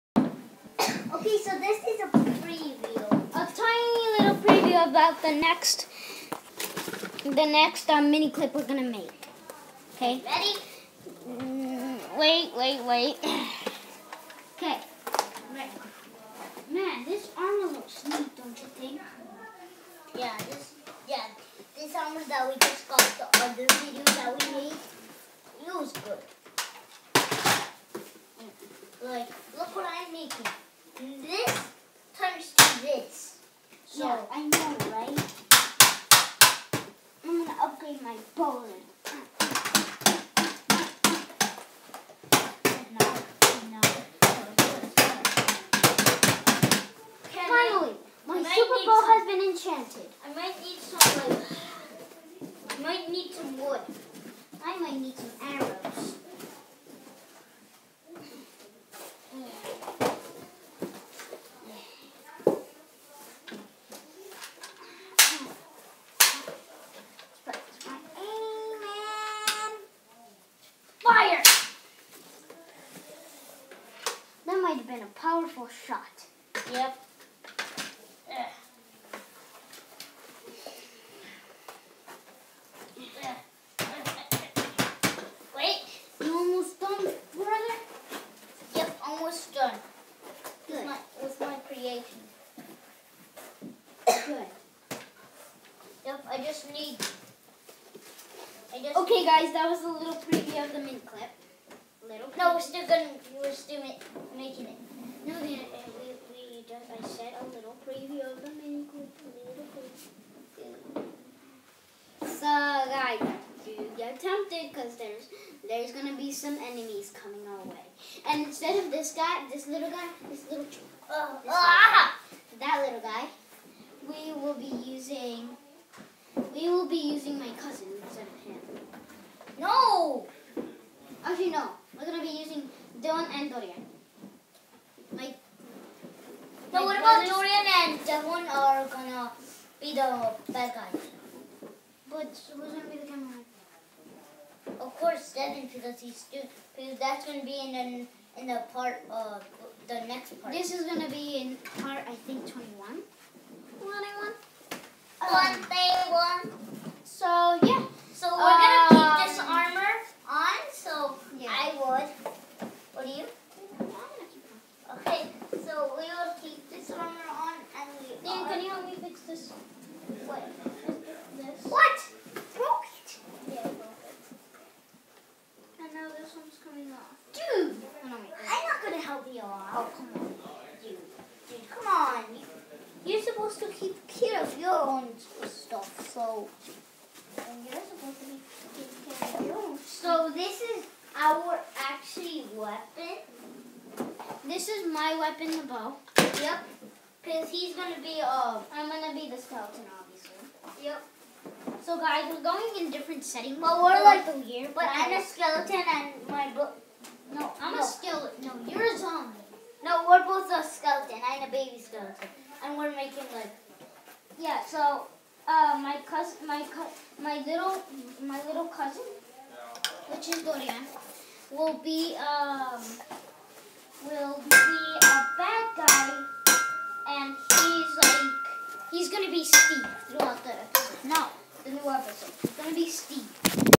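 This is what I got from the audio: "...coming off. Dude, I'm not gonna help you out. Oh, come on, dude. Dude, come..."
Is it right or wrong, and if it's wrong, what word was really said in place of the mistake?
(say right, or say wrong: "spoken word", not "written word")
right.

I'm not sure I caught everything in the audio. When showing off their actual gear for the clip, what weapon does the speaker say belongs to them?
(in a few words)
The bow.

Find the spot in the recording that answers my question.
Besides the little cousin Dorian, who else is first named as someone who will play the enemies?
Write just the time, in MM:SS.
02:13.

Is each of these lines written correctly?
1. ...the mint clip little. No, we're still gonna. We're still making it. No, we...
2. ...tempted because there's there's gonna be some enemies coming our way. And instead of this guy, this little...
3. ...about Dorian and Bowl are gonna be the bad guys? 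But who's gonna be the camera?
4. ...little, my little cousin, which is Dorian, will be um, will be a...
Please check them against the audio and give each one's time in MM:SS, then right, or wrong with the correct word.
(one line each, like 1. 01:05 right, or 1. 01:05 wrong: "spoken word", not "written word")
1. 01:40 right
2. 01:54 right
3. 02:16 wrong: "Devon", not "Bowl"
4. 03:37 right.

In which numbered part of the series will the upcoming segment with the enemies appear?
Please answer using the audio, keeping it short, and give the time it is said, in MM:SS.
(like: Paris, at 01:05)
21, at 02:32.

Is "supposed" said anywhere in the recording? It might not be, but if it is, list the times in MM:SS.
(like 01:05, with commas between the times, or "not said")
03:03, 03:07.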